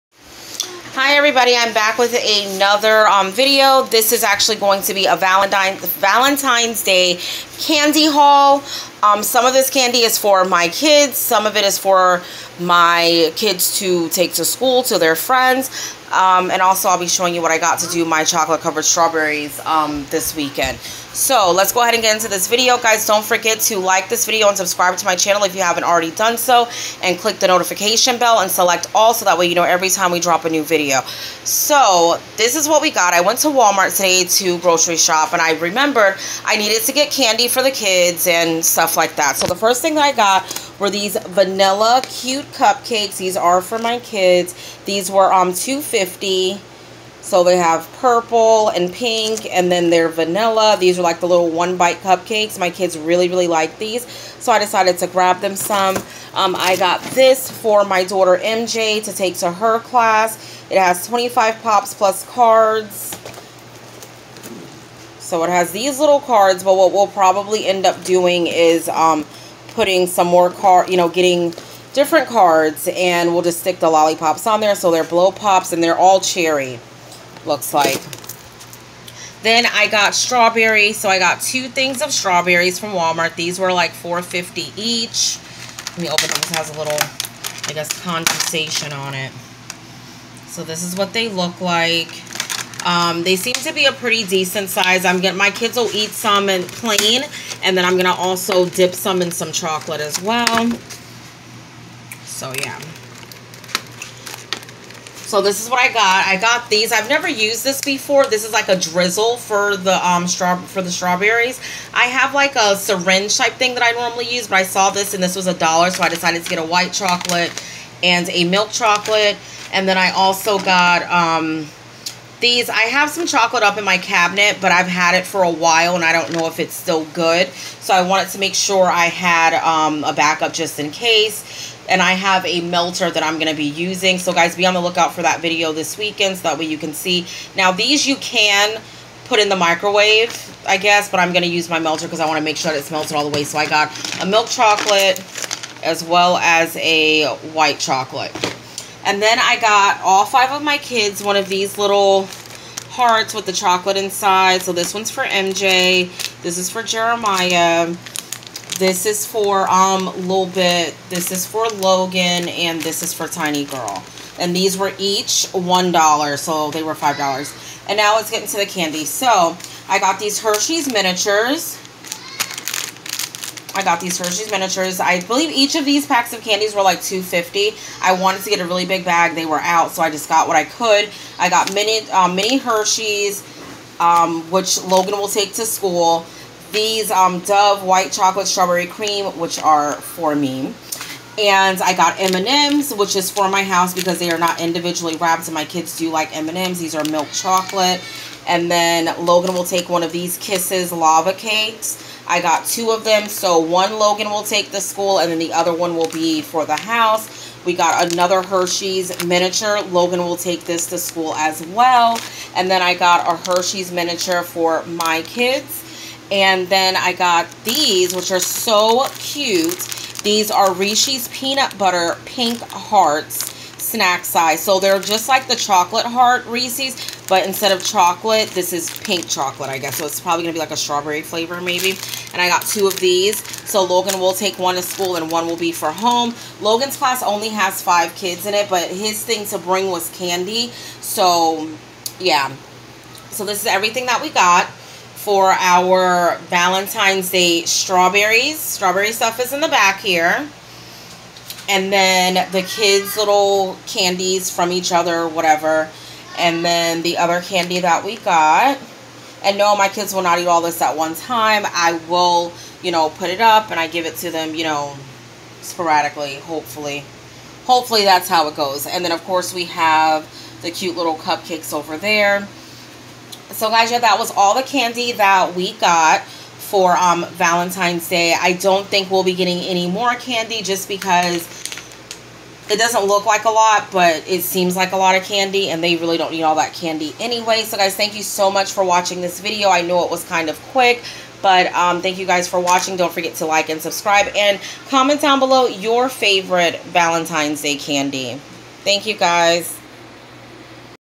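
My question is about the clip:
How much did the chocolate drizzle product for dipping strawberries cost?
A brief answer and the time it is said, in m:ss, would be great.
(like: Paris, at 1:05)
$1, at 1:55.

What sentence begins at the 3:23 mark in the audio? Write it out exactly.
So one Logan will take to school and then the other one will be for the house.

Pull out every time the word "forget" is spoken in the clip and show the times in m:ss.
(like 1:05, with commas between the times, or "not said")
0:23, 4:53.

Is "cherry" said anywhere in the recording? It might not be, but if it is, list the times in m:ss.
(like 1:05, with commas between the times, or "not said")
1:16.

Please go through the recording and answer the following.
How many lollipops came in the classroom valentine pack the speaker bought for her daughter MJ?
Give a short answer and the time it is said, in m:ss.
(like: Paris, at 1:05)
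25, at 1:01.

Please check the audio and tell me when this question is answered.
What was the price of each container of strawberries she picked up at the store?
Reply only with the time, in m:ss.
1:23.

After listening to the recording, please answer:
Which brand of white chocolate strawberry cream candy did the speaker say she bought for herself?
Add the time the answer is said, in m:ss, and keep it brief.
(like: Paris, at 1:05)
Dove, at 3:07.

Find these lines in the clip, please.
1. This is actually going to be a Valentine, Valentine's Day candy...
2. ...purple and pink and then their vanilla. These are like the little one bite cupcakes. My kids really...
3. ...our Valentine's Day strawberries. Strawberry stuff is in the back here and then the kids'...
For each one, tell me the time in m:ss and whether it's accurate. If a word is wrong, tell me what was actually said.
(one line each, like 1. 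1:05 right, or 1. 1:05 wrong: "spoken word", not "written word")
1. 0:03 right
2. 0:47 right
3. 4:05 right.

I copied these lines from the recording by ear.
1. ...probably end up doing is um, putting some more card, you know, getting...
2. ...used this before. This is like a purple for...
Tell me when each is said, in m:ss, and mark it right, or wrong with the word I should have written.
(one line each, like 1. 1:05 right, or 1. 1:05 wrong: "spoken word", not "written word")
1. 1:07 right
2. 1:47 wrong: "drizzle", not "purple".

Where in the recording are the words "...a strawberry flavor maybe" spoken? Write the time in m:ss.
3:50.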